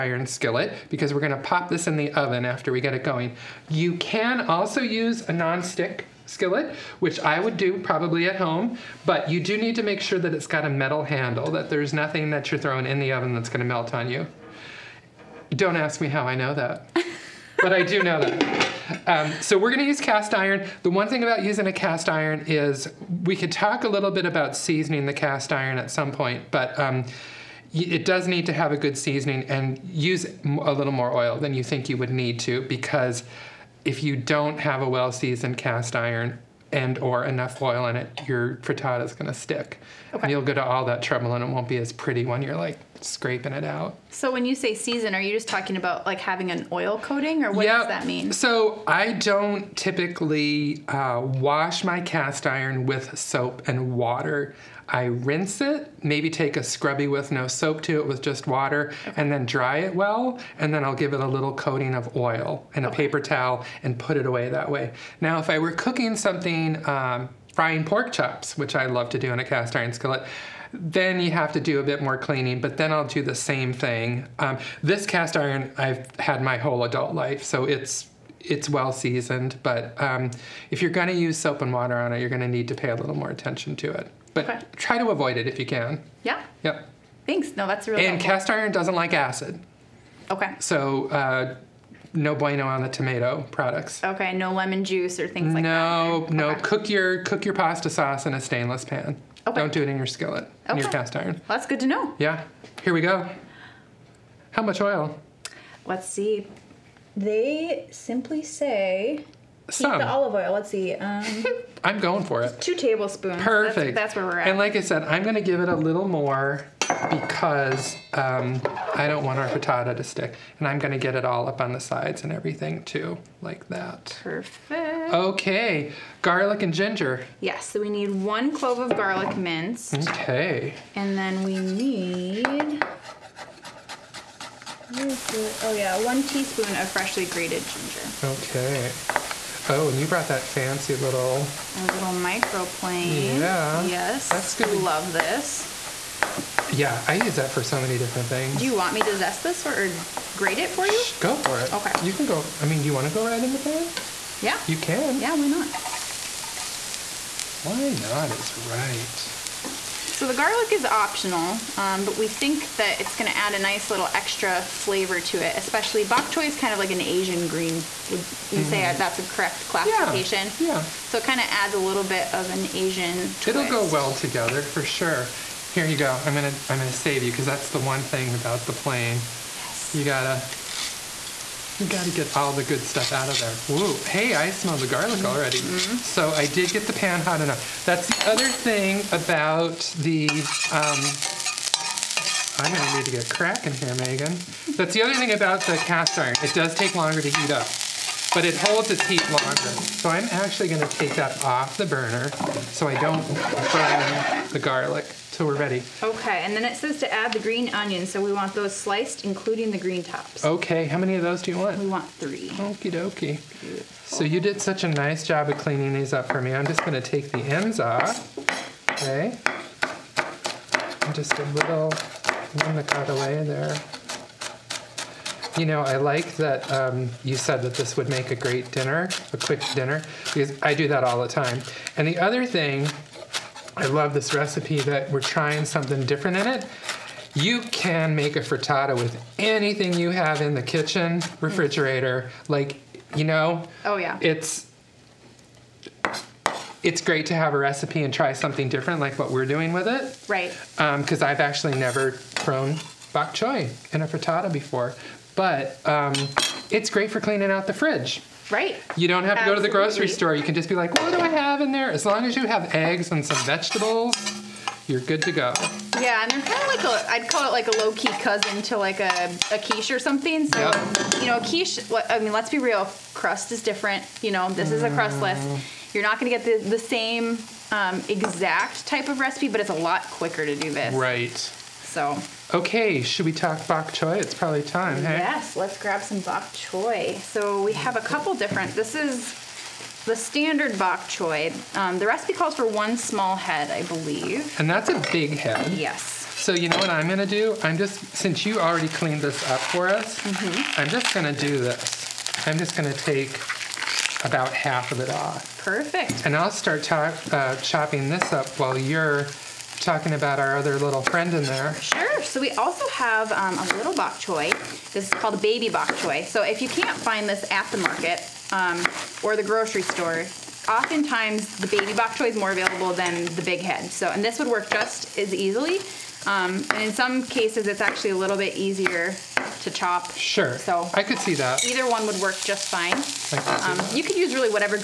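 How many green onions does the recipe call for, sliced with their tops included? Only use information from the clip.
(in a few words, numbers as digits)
3.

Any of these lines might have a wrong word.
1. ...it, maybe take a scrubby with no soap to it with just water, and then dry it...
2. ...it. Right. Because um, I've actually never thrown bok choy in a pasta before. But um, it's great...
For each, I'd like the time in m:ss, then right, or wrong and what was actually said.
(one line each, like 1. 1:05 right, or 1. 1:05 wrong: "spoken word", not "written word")
1. 0:55 right
2. 4:09 wrong: "frittata", not "pasta".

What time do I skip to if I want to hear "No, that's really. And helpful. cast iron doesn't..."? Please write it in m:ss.
1:27.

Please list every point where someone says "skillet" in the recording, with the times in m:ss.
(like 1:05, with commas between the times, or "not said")
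0:00, 0:06, 1:09, 1:40.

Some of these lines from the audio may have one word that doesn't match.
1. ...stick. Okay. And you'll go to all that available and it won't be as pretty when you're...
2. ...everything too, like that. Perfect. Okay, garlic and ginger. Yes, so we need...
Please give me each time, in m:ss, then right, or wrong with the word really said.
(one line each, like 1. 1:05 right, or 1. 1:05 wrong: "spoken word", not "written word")
1. 0:39 wrong: "trouble", not "available"
2. 2:02 right.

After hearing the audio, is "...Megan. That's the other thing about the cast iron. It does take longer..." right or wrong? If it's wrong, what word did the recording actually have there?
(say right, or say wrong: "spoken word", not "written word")
right.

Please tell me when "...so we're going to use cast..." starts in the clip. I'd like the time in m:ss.
0:19.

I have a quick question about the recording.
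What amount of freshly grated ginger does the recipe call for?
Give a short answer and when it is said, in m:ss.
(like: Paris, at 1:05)
1 teaspoon, at 2:16.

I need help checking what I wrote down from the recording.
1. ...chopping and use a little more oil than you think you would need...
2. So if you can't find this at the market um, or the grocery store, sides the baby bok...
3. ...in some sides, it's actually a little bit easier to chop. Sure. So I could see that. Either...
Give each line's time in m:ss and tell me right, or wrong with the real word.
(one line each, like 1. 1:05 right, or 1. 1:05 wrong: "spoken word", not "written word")
1. 0:28 wrong: "seasoning", not "chopping"
2. 5:16 wrong: "oftentimes", not "sides"
3. 5:26 wrong: "cases", not "sides".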